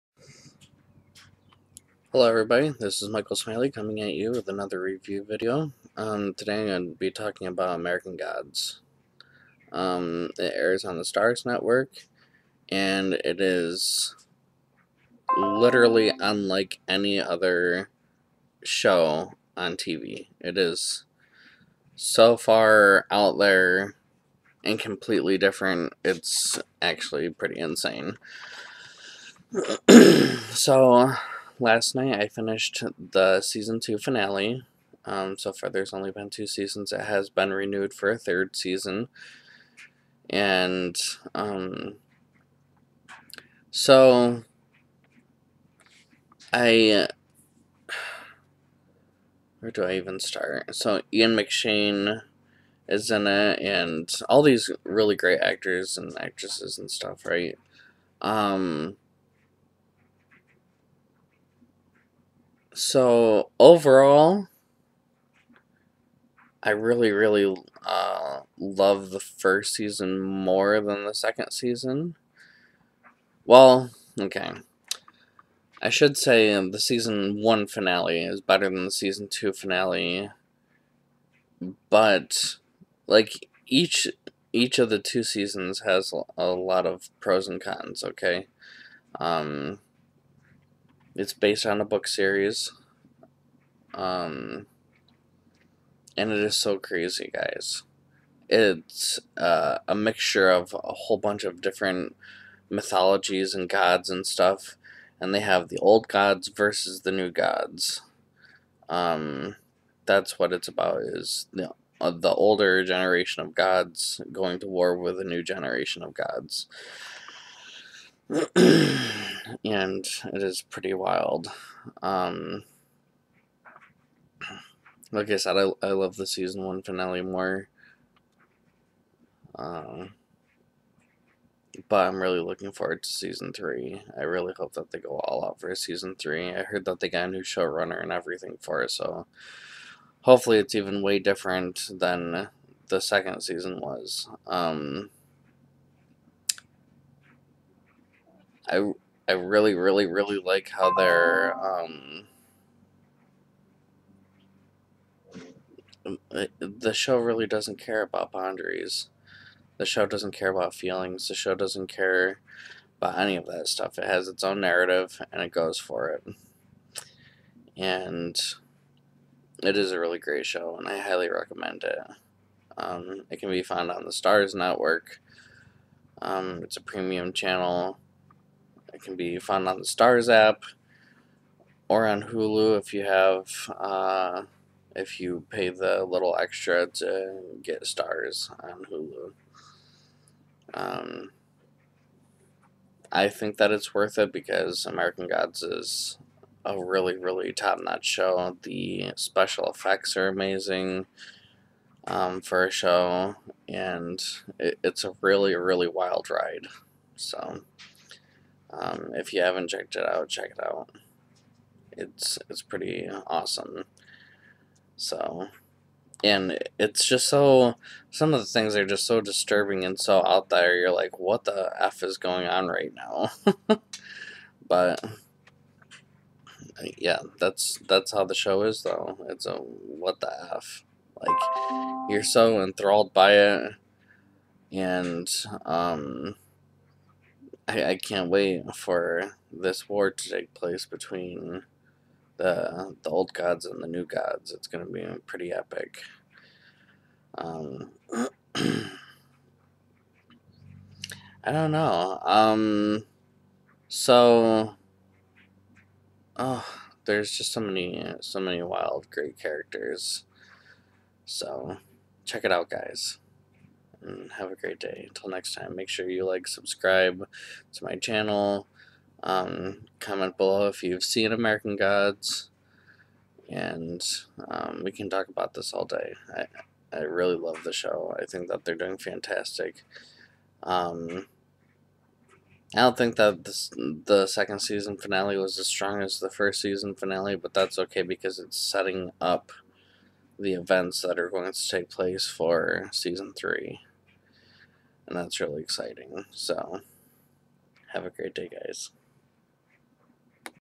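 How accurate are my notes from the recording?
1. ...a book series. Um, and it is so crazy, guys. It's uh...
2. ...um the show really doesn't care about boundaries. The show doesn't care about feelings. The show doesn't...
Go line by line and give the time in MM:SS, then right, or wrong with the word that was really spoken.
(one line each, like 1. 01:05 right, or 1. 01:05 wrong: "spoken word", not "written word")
1. 01:31 right
2. 02:36 right.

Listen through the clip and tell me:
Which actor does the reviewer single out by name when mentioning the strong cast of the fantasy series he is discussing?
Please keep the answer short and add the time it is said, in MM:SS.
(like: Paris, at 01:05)
Ian McShane, at 00:51.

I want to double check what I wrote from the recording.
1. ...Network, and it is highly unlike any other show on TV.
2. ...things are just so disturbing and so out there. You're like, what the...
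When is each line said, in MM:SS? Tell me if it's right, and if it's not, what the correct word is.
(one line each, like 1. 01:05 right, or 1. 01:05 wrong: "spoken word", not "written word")
1. 00:11 wrong: "literally", not "highly"
2. 03:38 right.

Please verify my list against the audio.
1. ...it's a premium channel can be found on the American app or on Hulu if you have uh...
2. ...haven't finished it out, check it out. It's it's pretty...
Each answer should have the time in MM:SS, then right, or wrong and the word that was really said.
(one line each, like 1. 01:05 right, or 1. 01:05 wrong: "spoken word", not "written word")
1. 02:56 wrong: "Starz", not "American"
2. 03:29 wrong: "checked", not "finished".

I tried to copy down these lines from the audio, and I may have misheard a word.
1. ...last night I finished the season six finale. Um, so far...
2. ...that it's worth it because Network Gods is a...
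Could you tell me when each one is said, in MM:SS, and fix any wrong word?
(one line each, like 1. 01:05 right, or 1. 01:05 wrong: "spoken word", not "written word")
1. 00:31 wrong: "two", not "six"
2. 03:13 wrong: "American", not "Network".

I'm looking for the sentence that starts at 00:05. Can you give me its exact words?
Um, today I'm going to be talking about American Gods.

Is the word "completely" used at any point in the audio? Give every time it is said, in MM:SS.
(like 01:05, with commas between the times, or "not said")
00:24.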